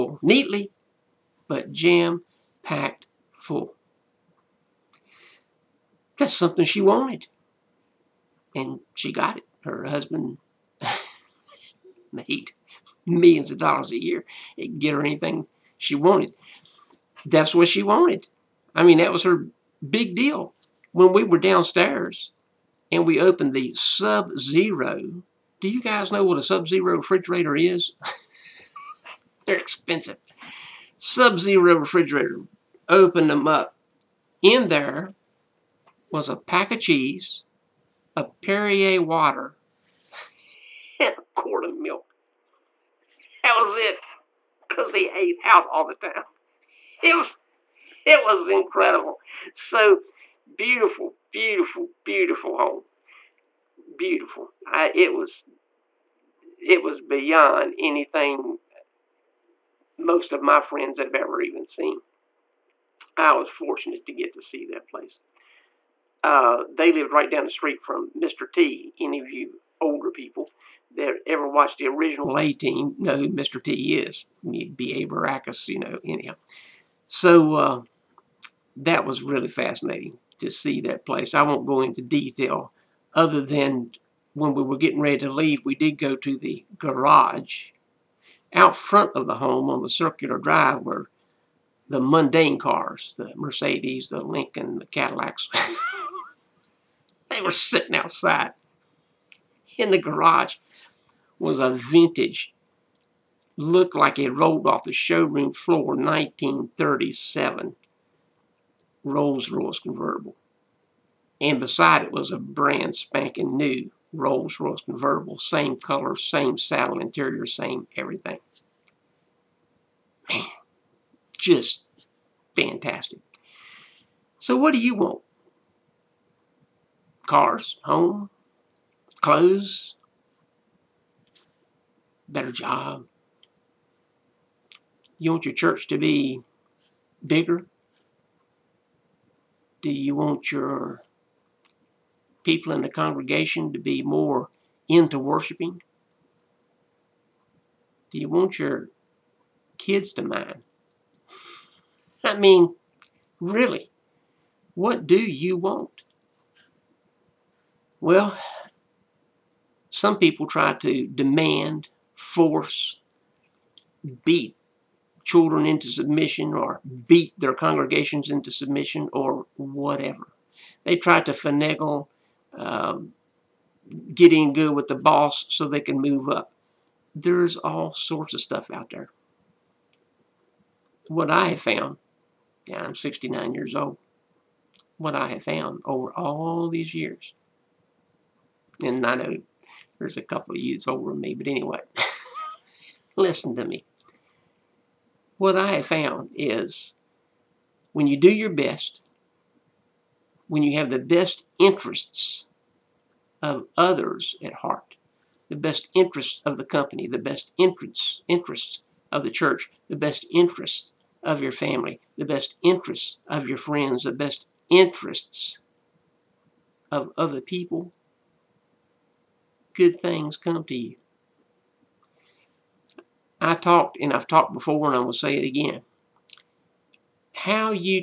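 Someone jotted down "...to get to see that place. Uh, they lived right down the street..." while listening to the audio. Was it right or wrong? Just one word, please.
right.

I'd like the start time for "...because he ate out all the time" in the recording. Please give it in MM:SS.
00:44.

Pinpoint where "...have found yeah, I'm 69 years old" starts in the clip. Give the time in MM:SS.
03:01.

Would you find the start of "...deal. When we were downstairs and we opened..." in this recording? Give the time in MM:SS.
00:20.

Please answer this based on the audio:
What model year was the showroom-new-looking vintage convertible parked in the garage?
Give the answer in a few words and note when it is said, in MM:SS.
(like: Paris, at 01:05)
1937, at 01:45.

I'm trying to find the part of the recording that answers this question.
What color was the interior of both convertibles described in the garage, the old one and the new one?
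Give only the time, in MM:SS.
01:56.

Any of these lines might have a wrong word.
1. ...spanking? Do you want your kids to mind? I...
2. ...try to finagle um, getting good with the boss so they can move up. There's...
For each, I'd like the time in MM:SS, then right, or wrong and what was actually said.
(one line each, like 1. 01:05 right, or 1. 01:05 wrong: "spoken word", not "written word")
1. 02:25 wrong: "worshiping", not "spanking"
2. 02:50 right.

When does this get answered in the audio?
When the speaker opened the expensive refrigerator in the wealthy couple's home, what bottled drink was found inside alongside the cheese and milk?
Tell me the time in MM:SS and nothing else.
00:38.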